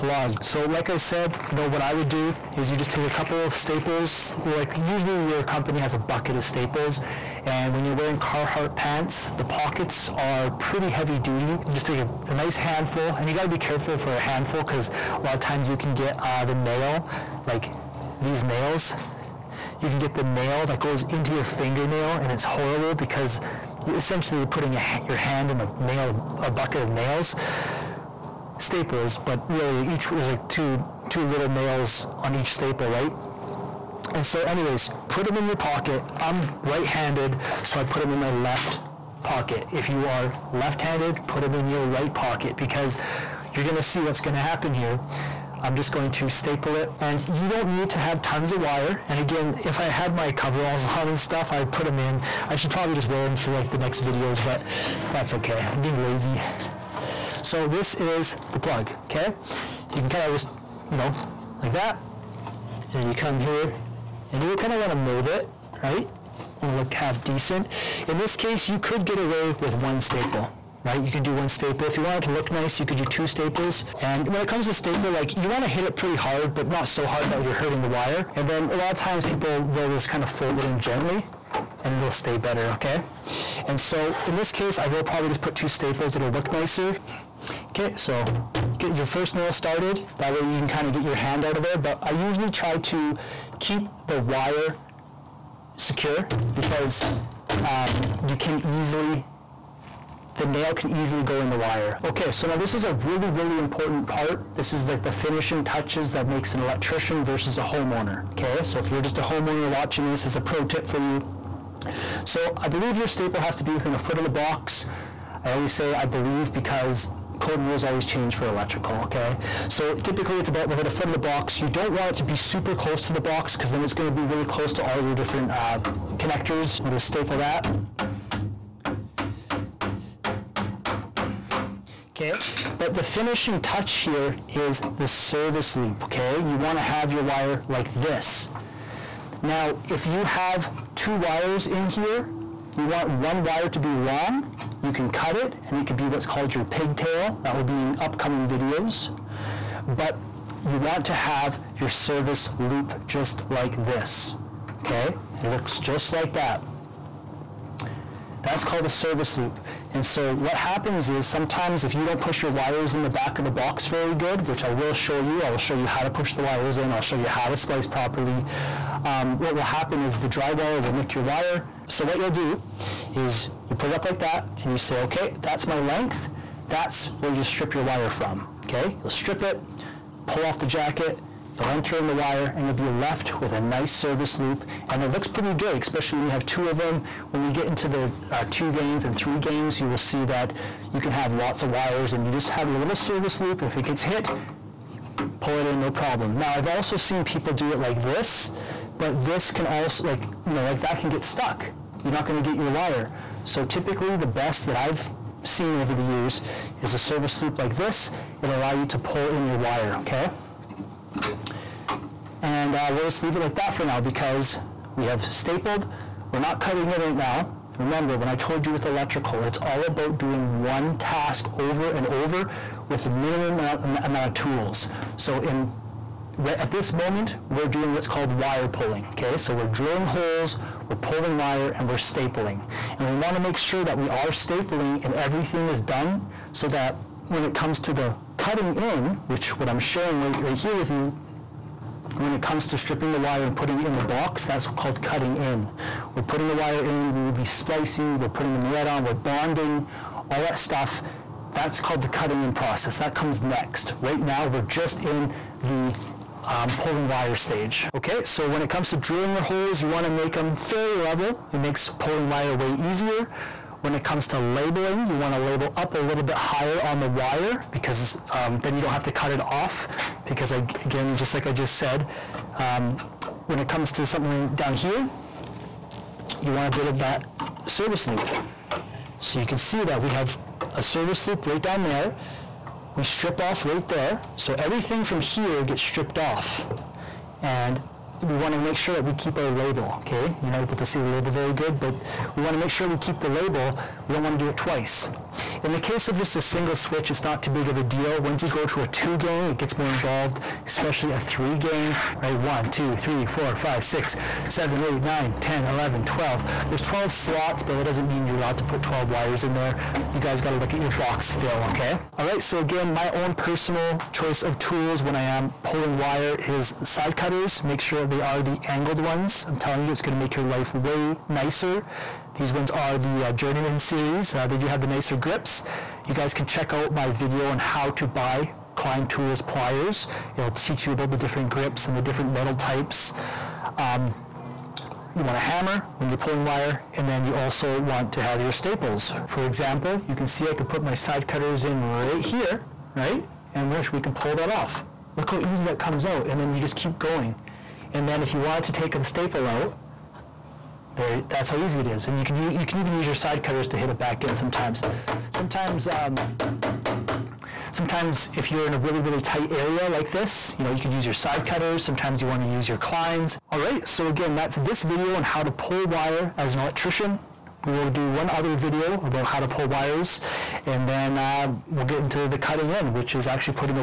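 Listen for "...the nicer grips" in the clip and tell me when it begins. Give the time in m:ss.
5:24.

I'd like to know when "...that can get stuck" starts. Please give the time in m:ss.
3:20.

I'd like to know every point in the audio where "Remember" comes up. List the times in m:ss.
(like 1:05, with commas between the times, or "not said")
3:37.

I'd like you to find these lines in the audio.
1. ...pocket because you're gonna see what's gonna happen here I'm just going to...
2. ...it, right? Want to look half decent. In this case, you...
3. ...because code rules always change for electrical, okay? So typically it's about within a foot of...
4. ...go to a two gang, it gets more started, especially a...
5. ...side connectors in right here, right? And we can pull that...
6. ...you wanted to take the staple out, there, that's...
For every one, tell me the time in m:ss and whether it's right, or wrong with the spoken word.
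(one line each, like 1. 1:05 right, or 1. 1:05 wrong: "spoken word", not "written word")
1. 0:42 right
2. 1:05 right
3. 1:56 right
4. 4:58 wrong: "involved", not "started"
5. 5:40 wrong: "cutters", not "connectors"
6. 5:48 right.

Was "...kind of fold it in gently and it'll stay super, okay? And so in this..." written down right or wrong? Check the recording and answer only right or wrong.
wrong.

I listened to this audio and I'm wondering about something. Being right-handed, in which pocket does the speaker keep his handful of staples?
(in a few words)
Left pocket.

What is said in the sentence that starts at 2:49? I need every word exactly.
Um, what will happen is the drywaller will nick your wire.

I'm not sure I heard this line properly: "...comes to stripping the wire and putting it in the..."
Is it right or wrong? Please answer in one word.
right.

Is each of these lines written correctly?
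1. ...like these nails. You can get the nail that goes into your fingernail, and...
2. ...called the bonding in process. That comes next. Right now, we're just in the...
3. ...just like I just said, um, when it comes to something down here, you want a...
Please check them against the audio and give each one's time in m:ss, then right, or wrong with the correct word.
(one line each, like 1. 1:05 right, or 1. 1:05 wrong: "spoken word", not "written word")
1. 0:17 right
2. 4:11 wrong: "cutting", not "bonding"
3. 4:31 right.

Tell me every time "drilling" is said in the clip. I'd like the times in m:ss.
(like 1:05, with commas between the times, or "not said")
3:49, 4:18.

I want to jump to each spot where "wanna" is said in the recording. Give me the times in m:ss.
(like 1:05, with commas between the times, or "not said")
2:16, 4:19.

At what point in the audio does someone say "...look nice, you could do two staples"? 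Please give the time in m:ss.
1:12.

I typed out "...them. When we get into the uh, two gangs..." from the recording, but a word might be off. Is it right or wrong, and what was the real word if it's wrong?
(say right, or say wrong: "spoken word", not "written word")
right.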